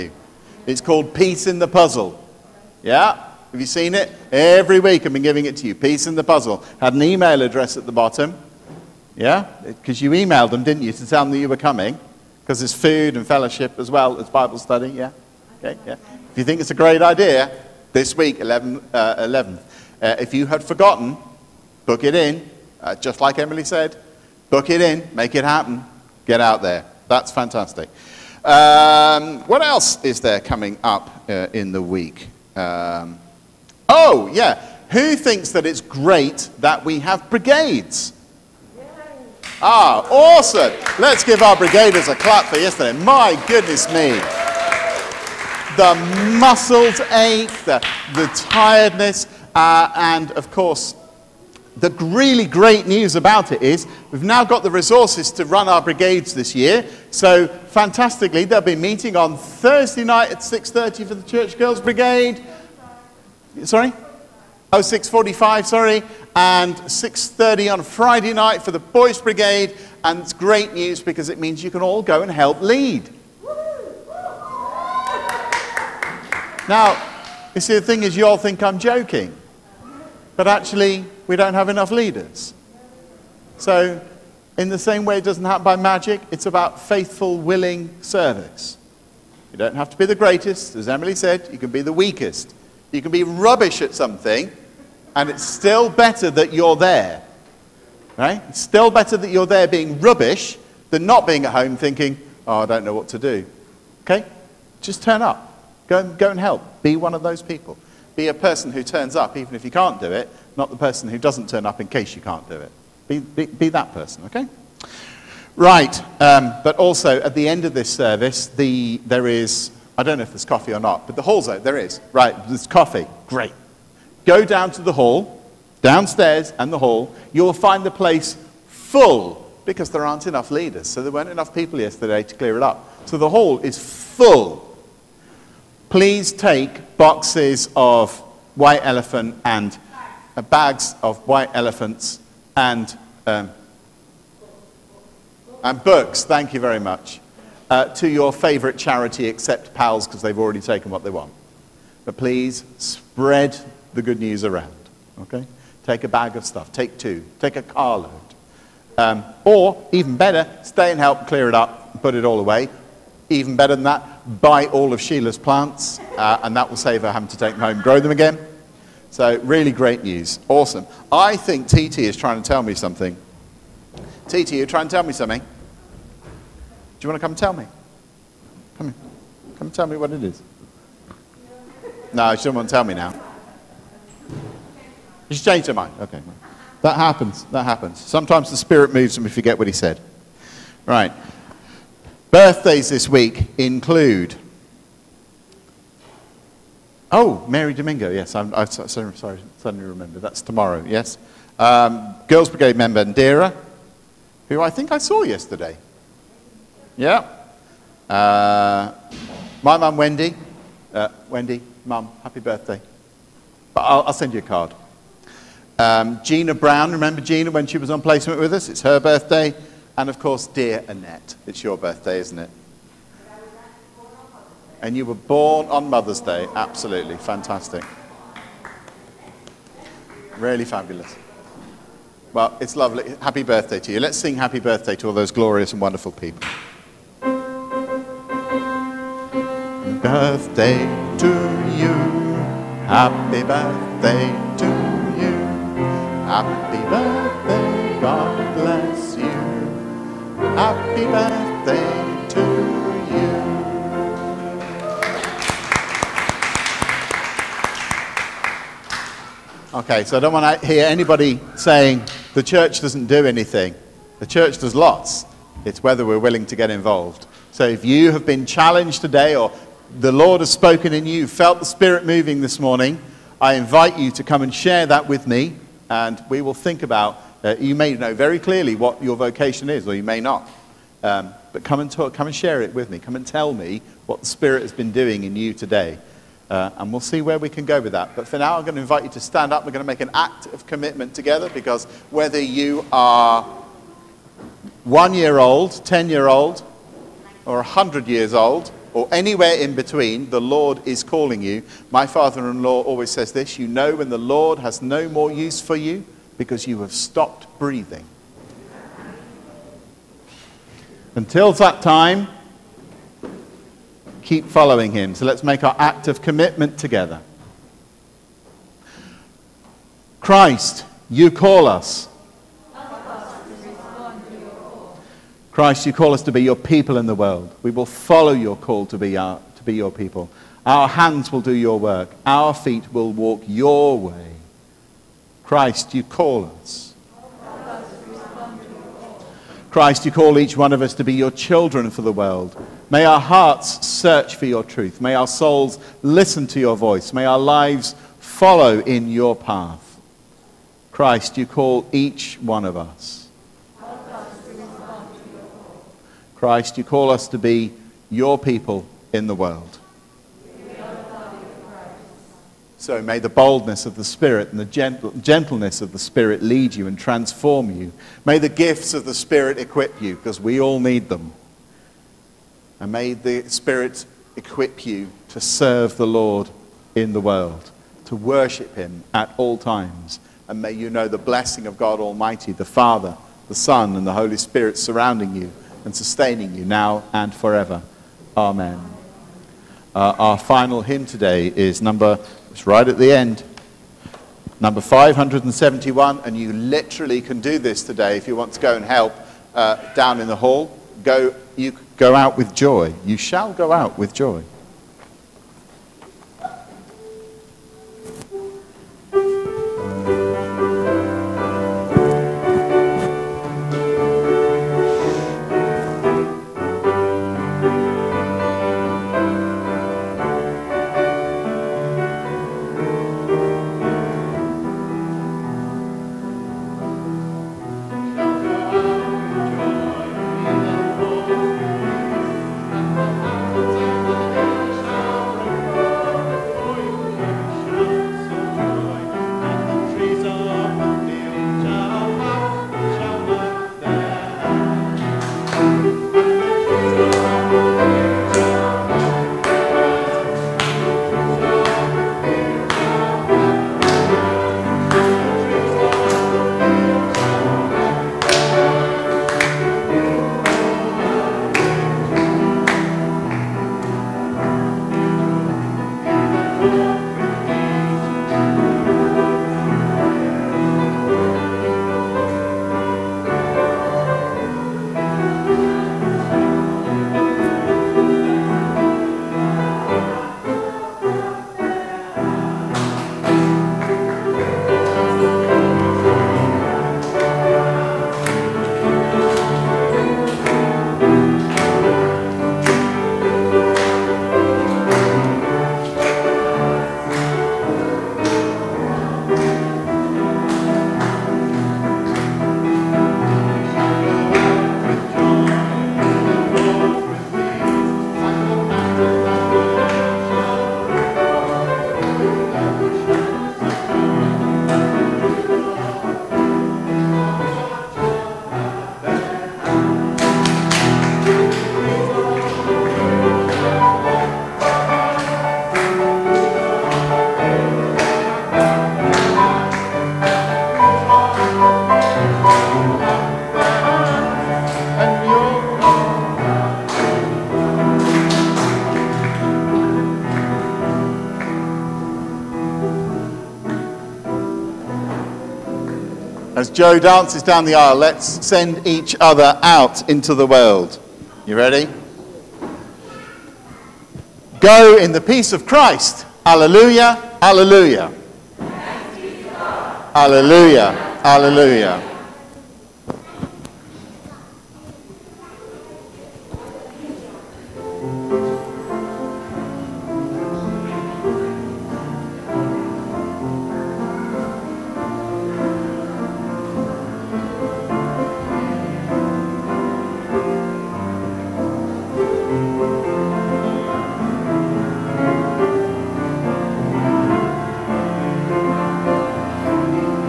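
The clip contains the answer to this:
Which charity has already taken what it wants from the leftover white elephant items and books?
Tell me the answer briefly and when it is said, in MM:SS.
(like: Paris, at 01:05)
PALS, at 02:29.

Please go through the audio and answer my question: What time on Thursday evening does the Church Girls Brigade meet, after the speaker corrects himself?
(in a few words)
6.45.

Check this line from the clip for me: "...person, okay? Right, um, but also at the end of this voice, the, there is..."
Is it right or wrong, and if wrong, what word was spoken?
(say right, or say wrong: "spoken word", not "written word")
wrong: "service", not "voice".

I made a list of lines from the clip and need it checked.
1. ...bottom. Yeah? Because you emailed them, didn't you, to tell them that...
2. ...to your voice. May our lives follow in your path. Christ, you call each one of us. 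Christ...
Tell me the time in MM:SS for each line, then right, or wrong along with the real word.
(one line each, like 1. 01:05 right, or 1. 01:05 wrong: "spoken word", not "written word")
1. 00:07 right
2. 05:46 right.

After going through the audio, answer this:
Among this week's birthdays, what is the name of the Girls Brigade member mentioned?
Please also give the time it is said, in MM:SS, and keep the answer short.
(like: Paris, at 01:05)
Ndira, at 03:23.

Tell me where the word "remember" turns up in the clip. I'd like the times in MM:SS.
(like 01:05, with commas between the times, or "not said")
03:19, 03:36.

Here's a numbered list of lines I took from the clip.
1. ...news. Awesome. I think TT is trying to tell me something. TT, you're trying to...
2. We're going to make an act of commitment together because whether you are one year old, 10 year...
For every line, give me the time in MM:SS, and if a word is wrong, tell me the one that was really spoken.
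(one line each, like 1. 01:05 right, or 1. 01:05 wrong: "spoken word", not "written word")
1. 02:50 right
2. 04:49 right.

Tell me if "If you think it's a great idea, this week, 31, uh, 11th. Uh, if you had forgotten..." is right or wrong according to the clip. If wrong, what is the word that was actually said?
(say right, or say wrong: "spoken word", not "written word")
wrong: "11", not "31".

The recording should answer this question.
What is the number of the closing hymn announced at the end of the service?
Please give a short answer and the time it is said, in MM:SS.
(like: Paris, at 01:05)
571, at 06:34.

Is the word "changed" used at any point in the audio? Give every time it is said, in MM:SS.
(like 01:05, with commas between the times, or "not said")
03:05.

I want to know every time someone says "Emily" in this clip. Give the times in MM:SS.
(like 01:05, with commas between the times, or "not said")
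00:23, 01:30.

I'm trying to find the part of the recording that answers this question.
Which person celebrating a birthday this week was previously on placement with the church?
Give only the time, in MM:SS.
03:36.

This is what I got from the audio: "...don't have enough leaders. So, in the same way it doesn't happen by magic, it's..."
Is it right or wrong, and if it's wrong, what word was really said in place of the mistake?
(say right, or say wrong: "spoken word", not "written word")
right.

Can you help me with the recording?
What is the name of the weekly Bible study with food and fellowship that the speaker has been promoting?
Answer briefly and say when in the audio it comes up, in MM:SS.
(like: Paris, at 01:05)
Peace in the Puzzle, at 00:01.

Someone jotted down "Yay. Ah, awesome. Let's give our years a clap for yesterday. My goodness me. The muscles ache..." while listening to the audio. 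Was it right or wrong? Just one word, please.
wrong.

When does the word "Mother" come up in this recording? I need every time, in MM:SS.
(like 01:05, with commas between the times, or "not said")
03:45.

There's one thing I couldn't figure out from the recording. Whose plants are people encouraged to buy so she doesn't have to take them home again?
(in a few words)
Sheila.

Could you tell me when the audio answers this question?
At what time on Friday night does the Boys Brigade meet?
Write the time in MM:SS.
01:06.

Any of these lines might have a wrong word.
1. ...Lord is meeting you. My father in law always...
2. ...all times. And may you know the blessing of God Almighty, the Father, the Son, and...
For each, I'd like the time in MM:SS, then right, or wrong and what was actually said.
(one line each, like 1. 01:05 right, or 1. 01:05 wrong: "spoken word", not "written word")
1. 05:00 wrong: "calling", not "meeting"
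2. 06:19 right.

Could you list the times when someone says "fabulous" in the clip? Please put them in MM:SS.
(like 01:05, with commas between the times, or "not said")
03:50.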